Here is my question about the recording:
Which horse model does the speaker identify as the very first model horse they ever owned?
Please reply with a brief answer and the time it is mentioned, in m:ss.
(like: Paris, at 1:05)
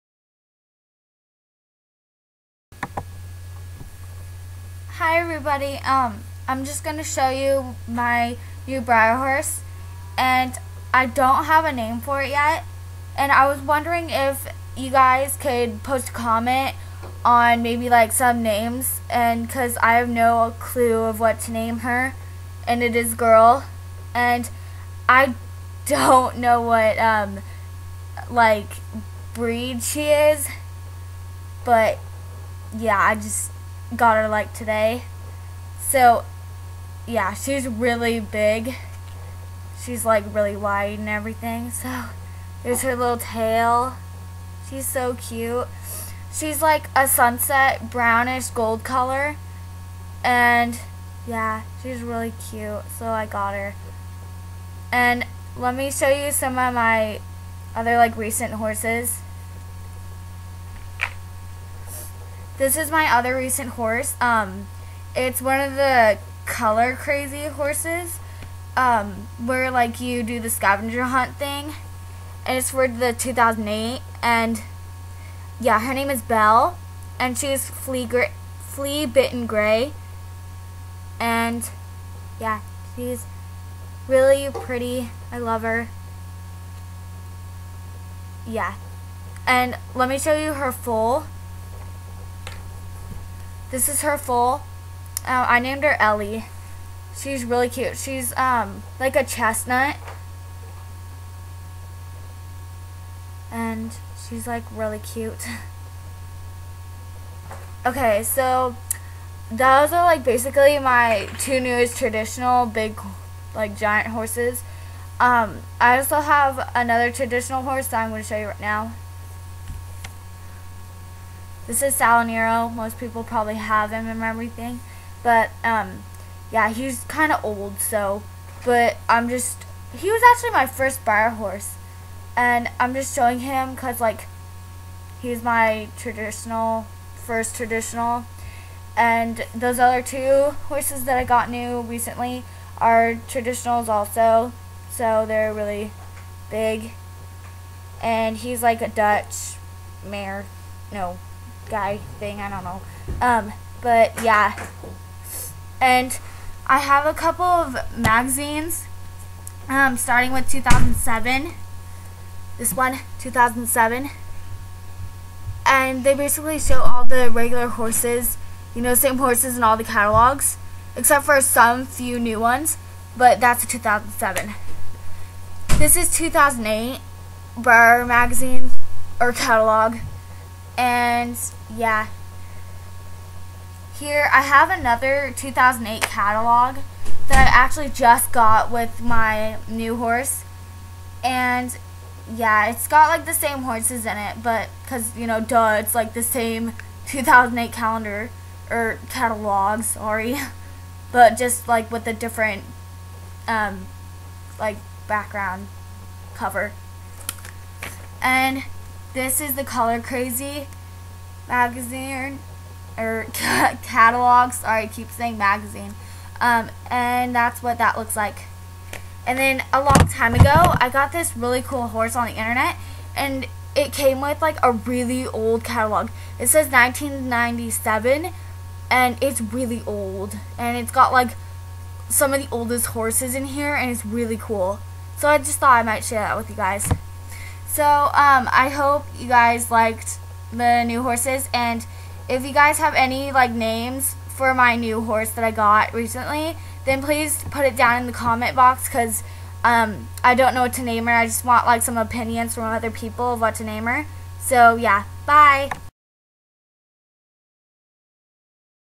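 Salinero, at 2:01.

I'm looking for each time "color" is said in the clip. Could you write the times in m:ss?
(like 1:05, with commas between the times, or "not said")
0:48, 1:06, 3:29.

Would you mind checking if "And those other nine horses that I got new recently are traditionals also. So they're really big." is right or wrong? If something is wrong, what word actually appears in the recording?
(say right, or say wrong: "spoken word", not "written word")
wrong: "two", not "nine".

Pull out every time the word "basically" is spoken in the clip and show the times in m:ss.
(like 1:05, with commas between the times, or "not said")
1:50, 2:46.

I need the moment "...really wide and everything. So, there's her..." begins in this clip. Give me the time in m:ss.
0:40.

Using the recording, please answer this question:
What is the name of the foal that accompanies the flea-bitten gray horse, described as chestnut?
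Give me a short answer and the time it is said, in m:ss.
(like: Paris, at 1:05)
Ellie, at 1:35.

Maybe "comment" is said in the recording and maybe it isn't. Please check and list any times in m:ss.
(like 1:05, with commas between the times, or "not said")
0:16, 4:08.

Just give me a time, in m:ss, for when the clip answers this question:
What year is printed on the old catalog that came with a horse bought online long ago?
3:46.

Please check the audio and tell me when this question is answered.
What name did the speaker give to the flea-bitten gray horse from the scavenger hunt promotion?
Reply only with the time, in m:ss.
1:16.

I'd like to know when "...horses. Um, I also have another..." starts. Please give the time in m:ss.
1:54.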